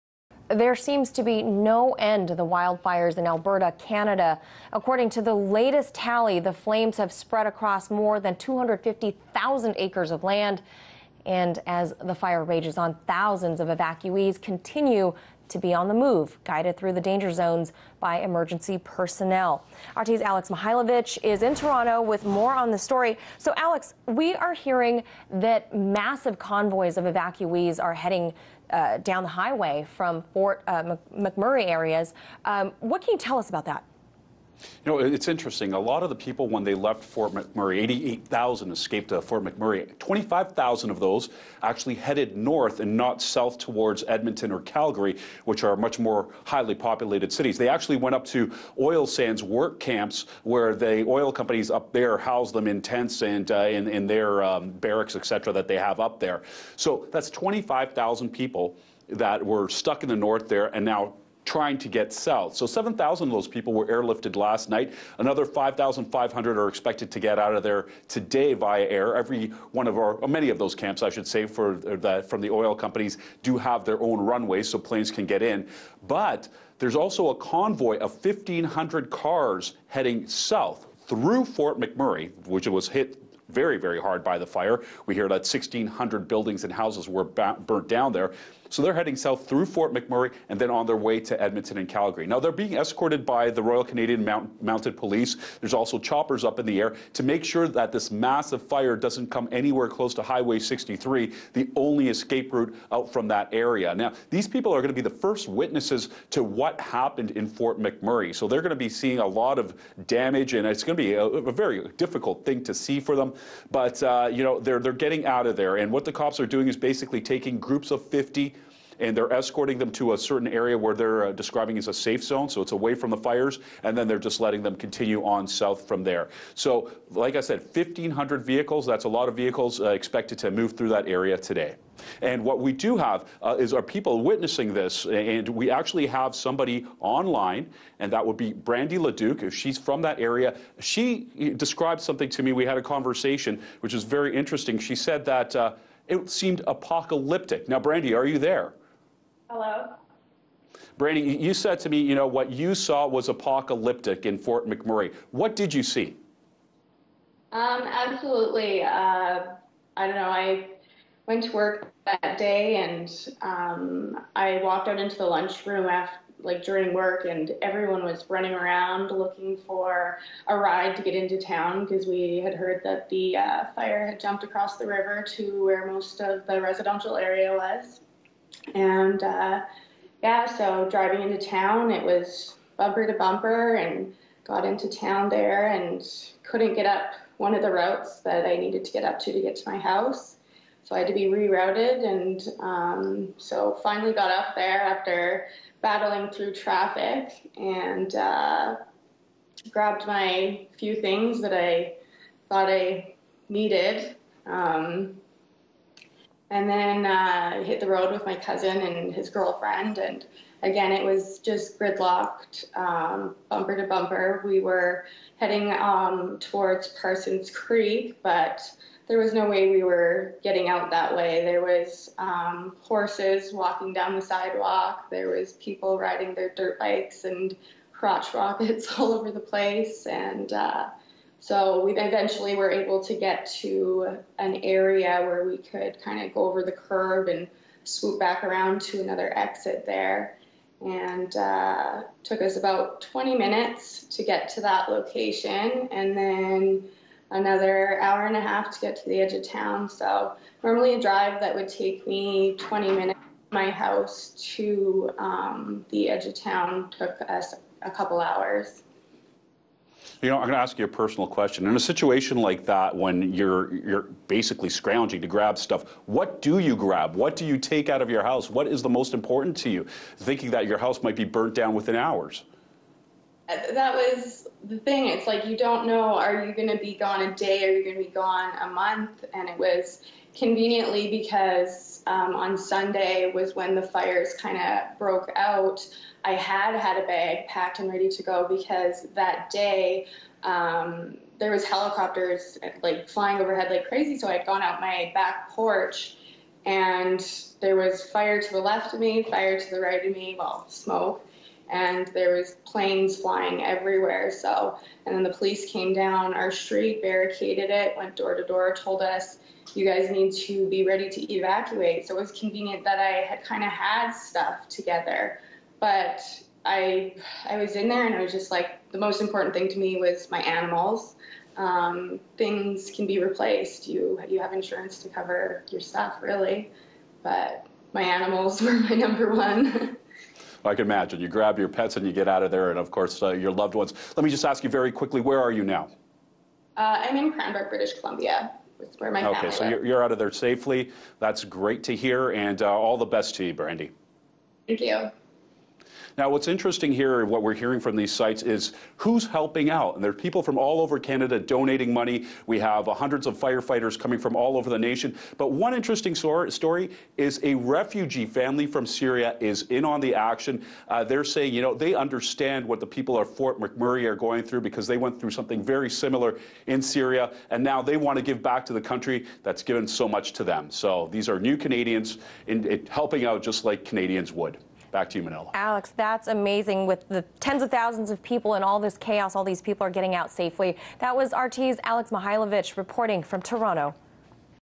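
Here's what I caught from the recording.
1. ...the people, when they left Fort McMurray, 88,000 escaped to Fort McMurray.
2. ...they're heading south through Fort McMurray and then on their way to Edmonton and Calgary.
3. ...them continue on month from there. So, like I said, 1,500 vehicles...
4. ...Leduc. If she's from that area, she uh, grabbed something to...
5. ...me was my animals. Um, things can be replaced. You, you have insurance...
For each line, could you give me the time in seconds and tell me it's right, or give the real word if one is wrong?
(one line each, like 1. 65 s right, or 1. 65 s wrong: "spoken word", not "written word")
1. 36 s right
2. 88 s right
3. 124 s wrong: "south", not "month"
4. 138 s wrong: "described", not "grabbed"
5. 319 s right.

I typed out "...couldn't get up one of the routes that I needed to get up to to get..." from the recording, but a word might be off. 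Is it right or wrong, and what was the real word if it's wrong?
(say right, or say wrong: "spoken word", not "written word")
right.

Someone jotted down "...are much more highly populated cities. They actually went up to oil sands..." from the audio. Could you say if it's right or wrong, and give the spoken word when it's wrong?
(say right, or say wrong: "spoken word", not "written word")
right.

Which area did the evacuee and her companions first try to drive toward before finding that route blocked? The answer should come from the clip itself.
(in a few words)
Parsons Creek.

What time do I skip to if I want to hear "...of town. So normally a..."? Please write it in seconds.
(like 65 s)
249 s.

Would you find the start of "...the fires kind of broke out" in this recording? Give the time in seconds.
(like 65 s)
283 s.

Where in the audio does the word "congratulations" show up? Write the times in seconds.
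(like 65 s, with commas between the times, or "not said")
not said.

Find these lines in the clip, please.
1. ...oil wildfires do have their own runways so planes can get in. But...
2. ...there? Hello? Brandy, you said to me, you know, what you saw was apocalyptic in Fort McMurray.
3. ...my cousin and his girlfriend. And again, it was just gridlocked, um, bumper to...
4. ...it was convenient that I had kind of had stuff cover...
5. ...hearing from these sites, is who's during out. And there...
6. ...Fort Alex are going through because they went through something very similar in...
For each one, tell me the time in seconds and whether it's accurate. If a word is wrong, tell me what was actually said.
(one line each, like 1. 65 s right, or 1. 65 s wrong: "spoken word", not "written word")
1. 72 s wrong: "companies", not "wildfires"
2. 148 s right
3. 208 s right
4. 312 s wrong: "together", not "cover"
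5. 347 s wrong: "helping", not "during"
6. 363 s wrong: "McMurray", not "Alex".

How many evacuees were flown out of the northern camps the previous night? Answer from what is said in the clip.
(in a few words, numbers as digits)
7,000.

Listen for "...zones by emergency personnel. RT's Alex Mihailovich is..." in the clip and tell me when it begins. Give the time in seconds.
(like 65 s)
17 s.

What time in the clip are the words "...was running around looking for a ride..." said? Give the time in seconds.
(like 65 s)
168 s.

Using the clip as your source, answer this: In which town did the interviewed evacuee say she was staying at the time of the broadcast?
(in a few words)
Cranbrook.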